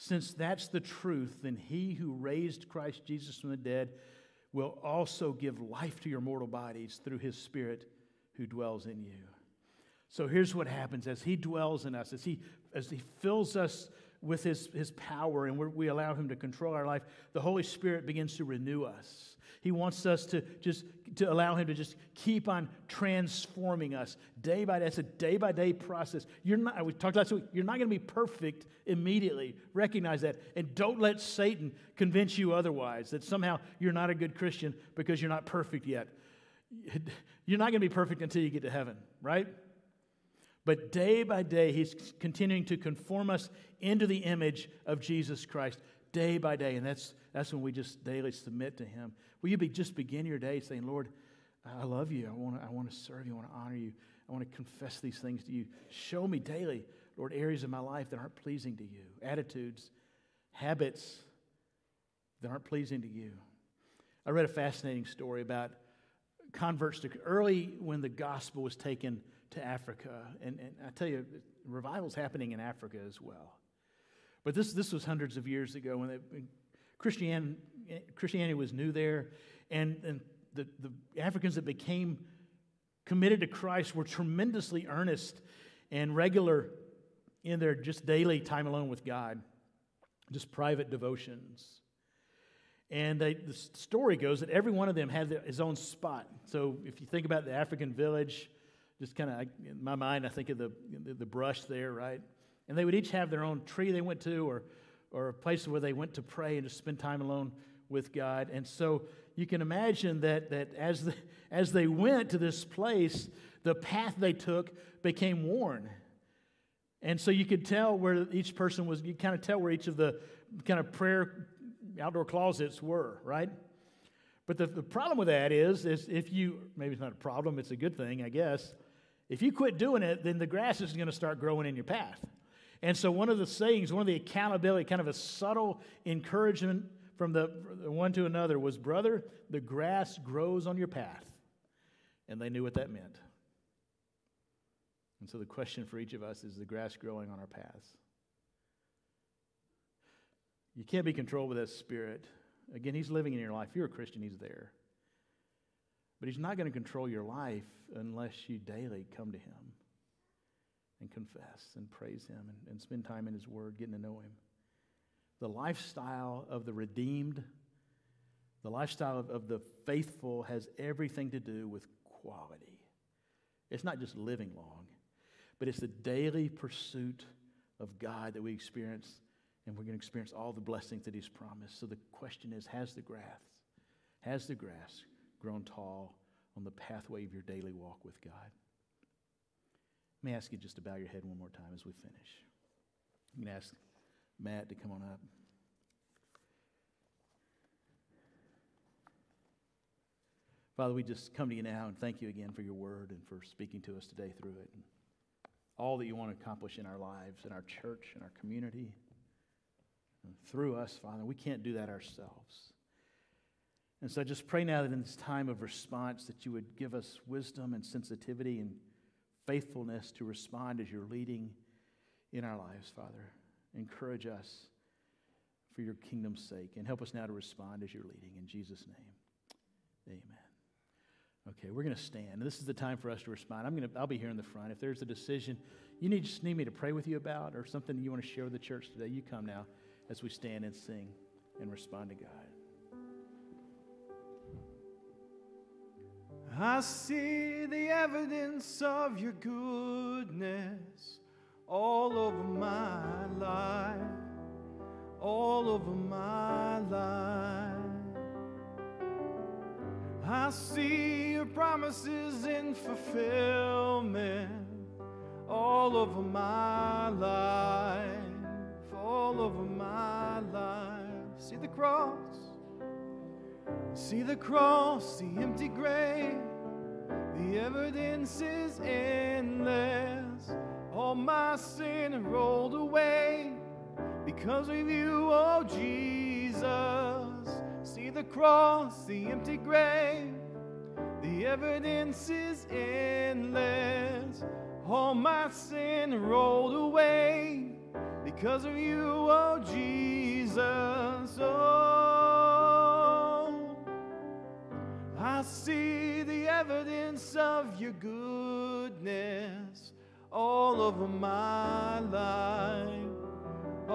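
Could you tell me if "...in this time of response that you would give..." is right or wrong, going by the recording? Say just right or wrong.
right.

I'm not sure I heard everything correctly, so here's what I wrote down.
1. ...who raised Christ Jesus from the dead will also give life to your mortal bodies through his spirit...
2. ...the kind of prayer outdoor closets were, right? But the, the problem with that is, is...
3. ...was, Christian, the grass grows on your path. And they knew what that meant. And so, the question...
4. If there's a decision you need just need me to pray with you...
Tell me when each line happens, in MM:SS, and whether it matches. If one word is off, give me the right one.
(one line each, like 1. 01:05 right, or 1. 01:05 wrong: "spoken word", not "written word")
1. 00:01 right
2. 01:59 right
3. 02:18 wrong: "Brother", not "Christian"
4. 03:54 right.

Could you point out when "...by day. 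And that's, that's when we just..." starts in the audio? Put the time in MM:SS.
00:46.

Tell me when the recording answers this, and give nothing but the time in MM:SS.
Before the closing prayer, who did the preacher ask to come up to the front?
03:14.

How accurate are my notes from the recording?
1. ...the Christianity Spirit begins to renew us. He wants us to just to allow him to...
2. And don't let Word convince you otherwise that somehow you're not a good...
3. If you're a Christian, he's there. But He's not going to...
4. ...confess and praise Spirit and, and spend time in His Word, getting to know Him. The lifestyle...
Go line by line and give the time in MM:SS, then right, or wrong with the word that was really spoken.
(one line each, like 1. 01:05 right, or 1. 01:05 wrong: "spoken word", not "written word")
1. 00:17 wrong: "Holy", not "Christianity"
2. 00:30 wrong: "Satan", not "Word"
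3. 02:33 right
4. 02:41 wrong: "Him", not "Spirit".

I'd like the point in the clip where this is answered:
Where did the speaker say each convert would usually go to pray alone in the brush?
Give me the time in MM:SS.
01:43.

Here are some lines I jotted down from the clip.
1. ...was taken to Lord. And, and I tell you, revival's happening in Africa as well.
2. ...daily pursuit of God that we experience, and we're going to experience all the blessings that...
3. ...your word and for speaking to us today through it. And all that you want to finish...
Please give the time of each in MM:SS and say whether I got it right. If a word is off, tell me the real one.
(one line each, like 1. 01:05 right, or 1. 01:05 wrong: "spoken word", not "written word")
1. 01:08 wrong: "Africa", not "Lord"
2. 02:55 right
3. 03:22 wrong: "accomplish", not "finish".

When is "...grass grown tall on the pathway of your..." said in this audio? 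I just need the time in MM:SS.
03:04.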